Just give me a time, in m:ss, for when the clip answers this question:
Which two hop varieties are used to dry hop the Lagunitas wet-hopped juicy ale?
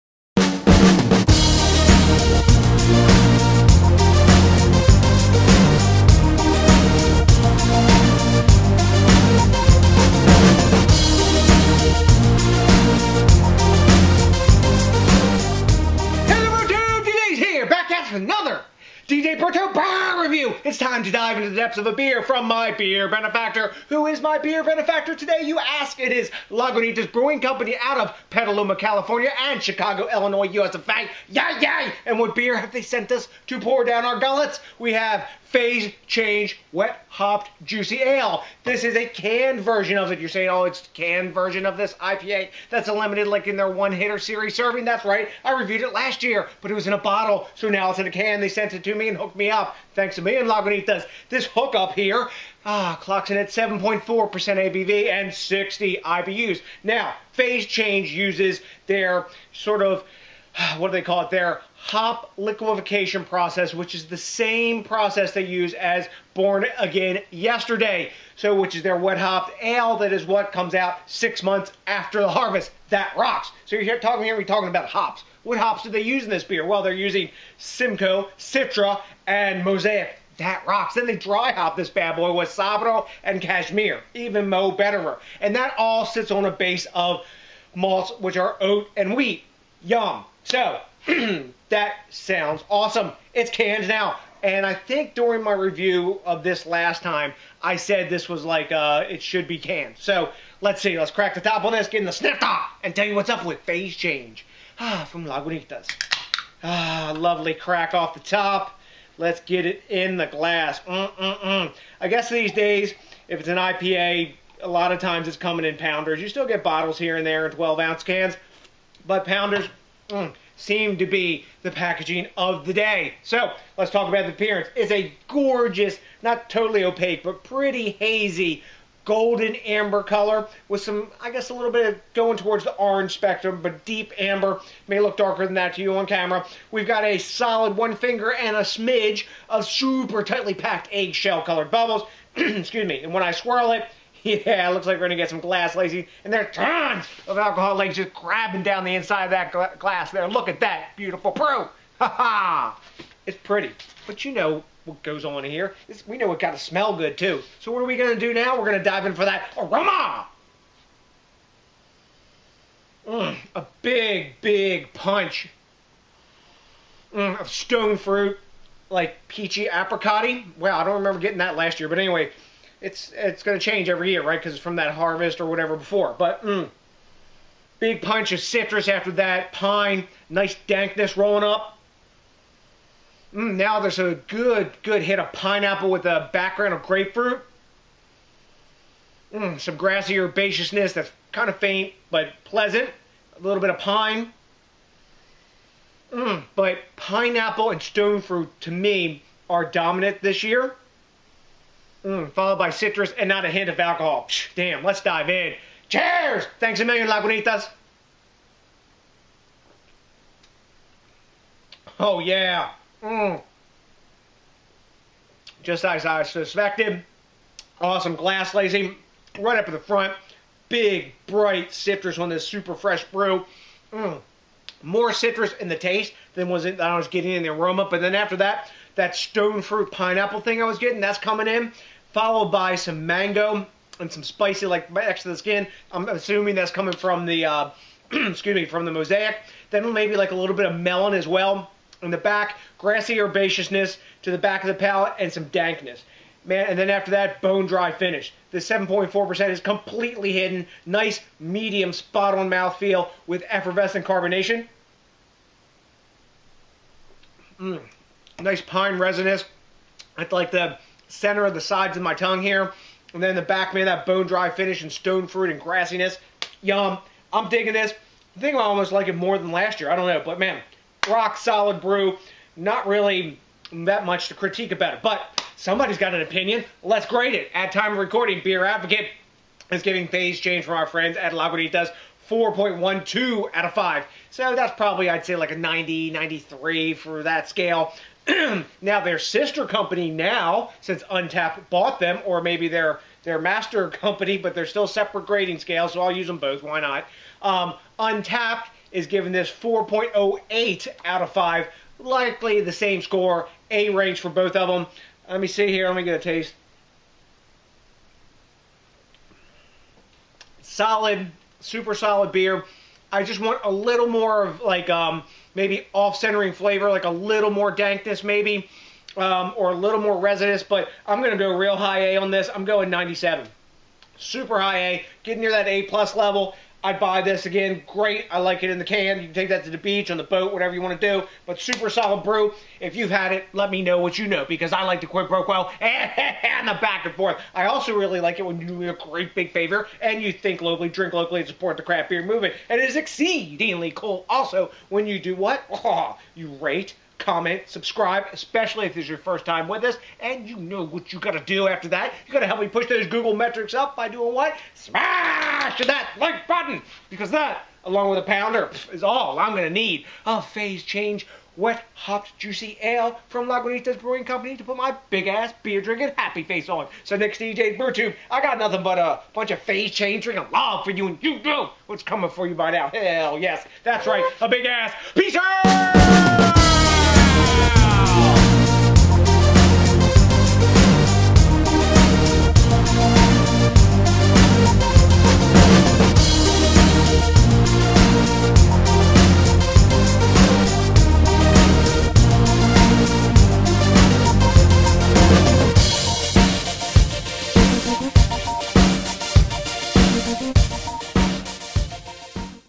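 1:22.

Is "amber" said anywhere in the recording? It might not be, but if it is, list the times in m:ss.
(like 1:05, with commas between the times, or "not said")
2:09, 2:14.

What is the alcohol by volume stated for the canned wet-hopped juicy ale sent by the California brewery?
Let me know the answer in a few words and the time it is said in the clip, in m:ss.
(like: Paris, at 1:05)
7.4%, at 0:53.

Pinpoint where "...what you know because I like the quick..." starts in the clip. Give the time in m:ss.
5:33.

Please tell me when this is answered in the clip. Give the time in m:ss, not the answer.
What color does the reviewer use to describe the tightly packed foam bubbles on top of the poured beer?
2:20.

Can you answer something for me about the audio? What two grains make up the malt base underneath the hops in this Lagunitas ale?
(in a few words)
Oat and wheat.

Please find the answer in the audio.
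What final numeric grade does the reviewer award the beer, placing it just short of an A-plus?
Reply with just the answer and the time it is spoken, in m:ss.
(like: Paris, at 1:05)
97, at 5:22.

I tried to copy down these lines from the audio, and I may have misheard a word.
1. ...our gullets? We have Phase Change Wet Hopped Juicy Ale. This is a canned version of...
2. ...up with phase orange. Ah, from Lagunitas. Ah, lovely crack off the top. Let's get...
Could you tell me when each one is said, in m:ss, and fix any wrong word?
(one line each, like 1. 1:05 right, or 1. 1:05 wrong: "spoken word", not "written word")
1. 0:34 right
2. 1:43 wrong: "change", not "orange".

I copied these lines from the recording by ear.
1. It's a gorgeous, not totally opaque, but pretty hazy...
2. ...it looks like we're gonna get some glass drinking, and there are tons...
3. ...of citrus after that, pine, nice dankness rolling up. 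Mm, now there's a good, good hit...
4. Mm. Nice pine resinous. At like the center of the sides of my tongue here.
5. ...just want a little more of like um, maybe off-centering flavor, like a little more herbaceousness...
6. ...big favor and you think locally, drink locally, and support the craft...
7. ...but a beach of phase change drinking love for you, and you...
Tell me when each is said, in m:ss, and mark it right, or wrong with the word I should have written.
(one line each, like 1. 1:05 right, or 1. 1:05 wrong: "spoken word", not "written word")
1. 2:04 right
2. 2:24 wrong: "lacing", not "drinking"
3. 2:58 right
4. 4:17 right
5. 5:13 wrong: "dankness", not "herbaceousness"
6. 5:39 right
7. 6:08 wrong: "bunch", not "beach".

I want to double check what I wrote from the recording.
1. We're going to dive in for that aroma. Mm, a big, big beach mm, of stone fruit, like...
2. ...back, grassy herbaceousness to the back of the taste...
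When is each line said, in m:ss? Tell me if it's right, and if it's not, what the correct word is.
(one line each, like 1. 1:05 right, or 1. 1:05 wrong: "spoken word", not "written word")
1. 2:38 wrong: "punch", not "beach"
2. 4:02 wrong: "palate", not "taste".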